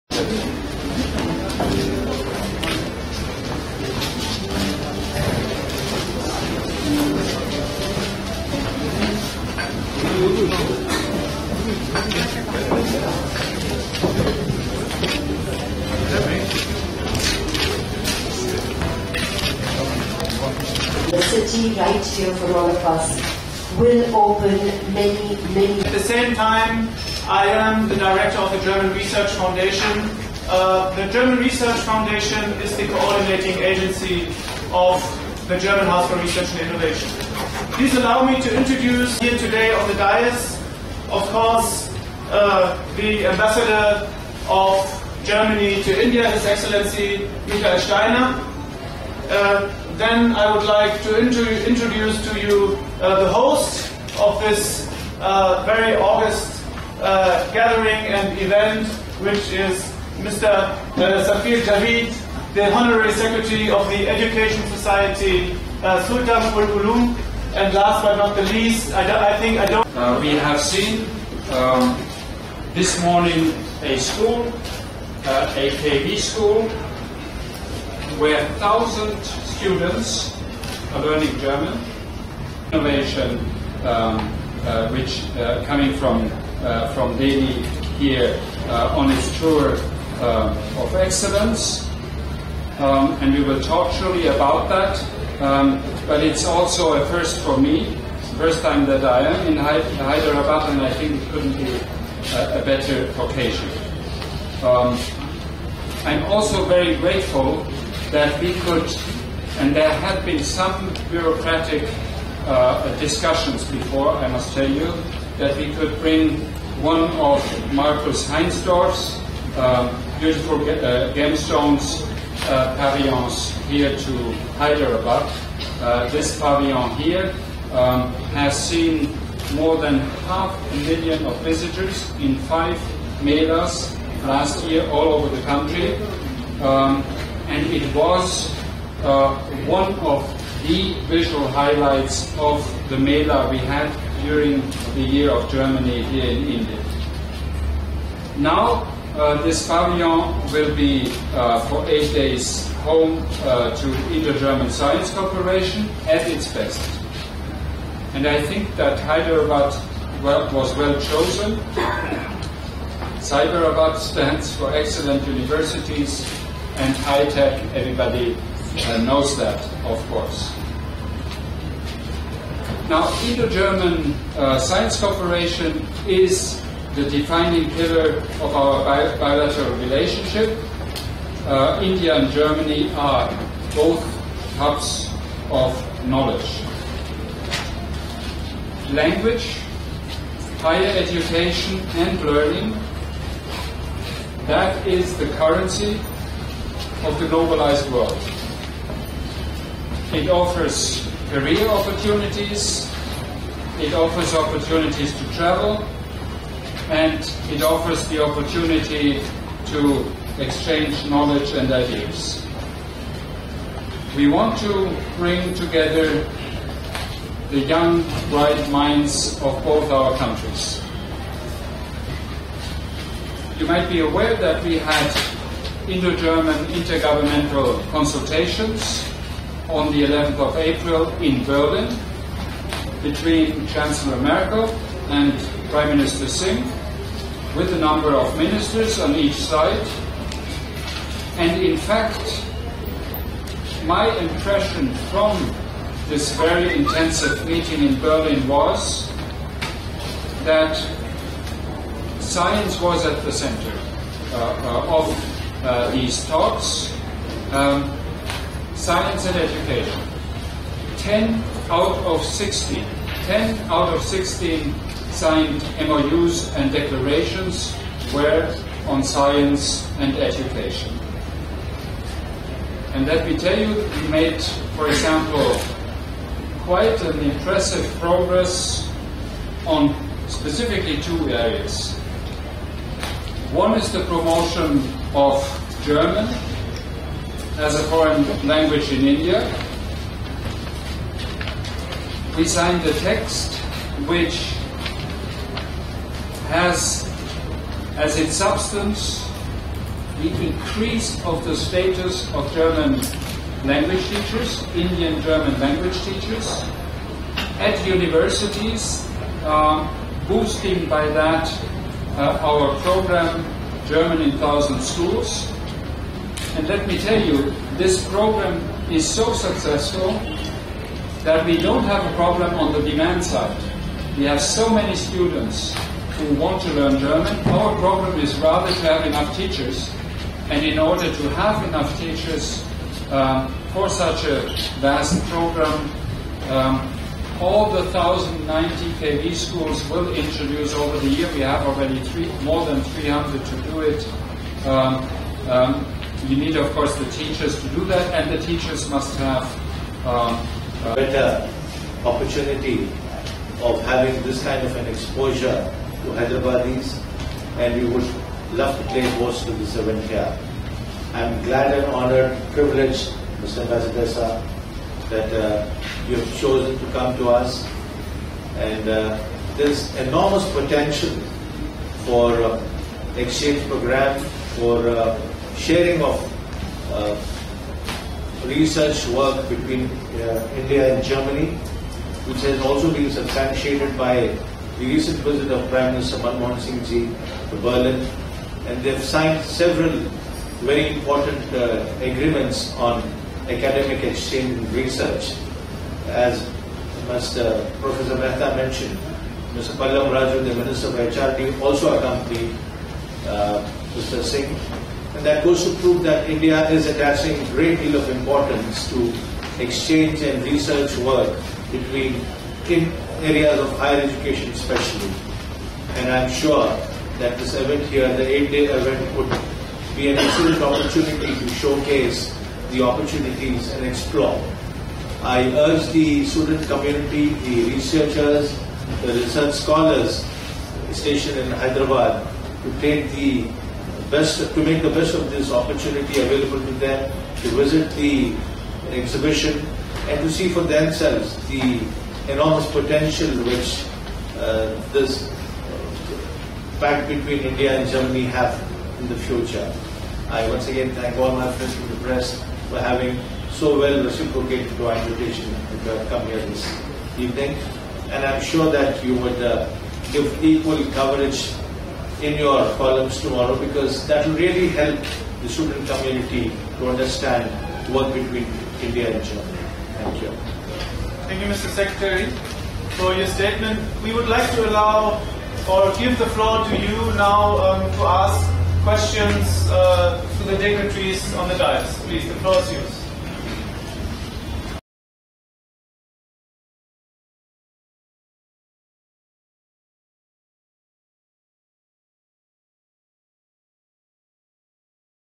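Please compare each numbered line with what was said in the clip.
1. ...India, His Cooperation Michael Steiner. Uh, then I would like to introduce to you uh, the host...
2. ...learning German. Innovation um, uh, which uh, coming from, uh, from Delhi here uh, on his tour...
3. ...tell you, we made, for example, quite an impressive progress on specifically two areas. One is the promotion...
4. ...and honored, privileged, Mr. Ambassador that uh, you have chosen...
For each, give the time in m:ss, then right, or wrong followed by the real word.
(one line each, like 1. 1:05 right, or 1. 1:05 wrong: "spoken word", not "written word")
1. 0:46 wrong: "Excellency", not "Cooperation"
2. 1:21 right
3. 4:33 right
4. 6:01 right.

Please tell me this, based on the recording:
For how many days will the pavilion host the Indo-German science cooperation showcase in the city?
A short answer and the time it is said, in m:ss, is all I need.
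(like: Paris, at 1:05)
8, at 2:31.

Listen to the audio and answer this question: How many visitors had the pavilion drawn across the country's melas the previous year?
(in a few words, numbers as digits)
more than half a million.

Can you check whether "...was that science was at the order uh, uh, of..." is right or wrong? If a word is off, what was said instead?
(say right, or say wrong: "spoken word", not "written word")
wrong: "center", not "order".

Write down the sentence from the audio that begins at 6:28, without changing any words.
And they have signed several very important agreements on academic exchange and research.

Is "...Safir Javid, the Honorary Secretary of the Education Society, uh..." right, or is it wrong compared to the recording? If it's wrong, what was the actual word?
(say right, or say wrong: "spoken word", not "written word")
right.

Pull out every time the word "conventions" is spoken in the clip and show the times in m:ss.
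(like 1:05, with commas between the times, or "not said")
not said.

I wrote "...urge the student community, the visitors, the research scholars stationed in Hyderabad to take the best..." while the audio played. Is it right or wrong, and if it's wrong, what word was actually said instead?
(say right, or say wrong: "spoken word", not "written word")
wrong: "researchers", not "visitors".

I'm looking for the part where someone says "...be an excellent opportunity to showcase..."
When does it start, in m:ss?
6:59.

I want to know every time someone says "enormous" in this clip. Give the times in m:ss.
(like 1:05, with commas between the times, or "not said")
6:10, 7:22.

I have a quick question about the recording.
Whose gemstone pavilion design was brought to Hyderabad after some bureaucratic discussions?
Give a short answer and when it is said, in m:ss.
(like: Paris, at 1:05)
Markus Heinsdorff, at 1:57.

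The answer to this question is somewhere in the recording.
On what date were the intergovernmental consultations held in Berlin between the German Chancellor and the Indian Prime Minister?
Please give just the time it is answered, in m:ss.
3:50.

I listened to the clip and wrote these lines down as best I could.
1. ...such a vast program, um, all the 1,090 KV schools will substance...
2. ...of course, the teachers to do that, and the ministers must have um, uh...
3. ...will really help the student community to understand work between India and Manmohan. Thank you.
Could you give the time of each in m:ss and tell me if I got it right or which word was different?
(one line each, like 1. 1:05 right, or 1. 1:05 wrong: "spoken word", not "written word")
1. 5:33 wrong: "introduce", not "substance"
2. 5:46 wrong: "teachers", not "ministers"
3. 7:44 wrong: "Germany", not "Manmohan".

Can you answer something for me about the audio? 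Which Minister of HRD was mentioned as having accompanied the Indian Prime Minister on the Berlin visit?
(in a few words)
Pallam Raju.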